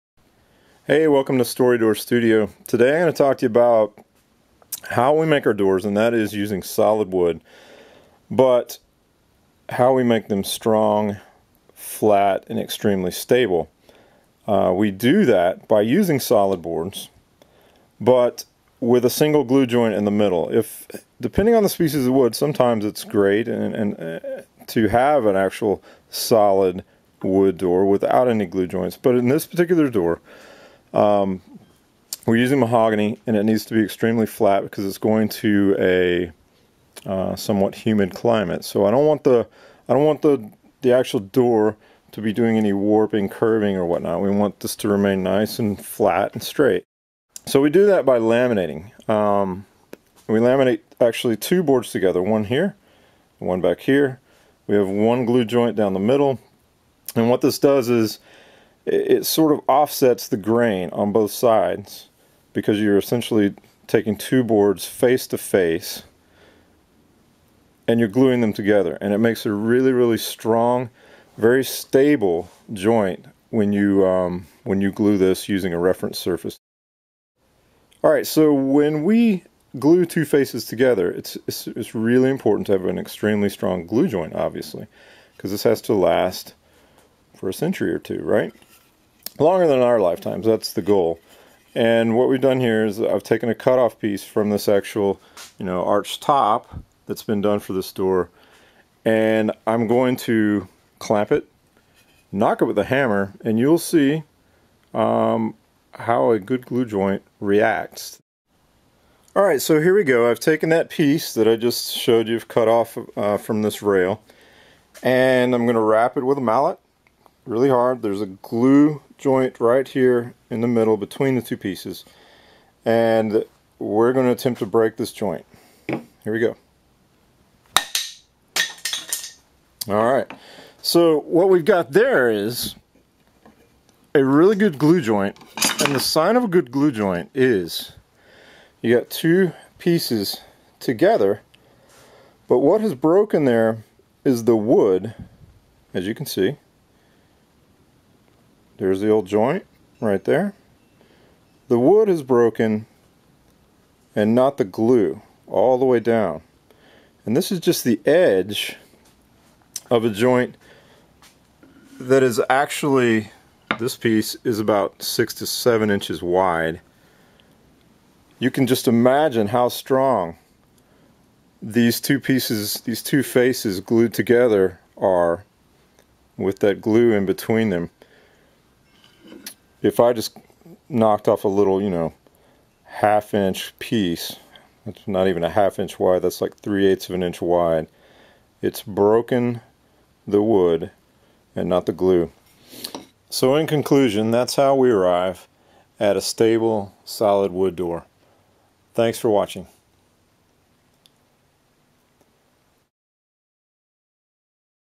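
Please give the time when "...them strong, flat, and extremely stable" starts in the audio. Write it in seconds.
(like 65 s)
10 s.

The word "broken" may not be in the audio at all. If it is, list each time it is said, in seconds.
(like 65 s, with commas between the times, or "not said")
142 s, 152 s, 188 s.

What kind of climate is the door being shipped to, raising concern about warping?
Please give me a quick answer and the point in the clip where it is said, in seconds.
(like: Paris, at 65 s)
somewhat humid, at 37 s.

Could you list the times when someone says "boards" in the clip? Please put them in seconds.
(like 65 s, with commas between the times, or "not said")
16 s, 51 s, 64 s.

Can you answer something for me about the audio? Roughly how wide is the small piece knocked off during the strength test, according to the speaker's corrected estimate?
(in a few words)
3/8 inch.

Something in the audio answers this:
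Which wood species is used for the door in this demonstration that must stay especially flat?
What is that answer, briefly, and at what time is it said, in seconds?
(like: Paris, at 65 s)
mahogany, at 32 s.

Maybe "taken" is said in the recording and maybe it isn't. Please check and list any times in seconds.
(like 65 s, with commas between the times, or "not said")
93 s, 110 s.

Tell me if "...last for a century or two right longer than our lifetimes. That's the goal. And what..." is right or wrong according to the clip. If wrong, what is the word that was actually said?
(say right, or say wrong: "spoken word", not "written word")
right.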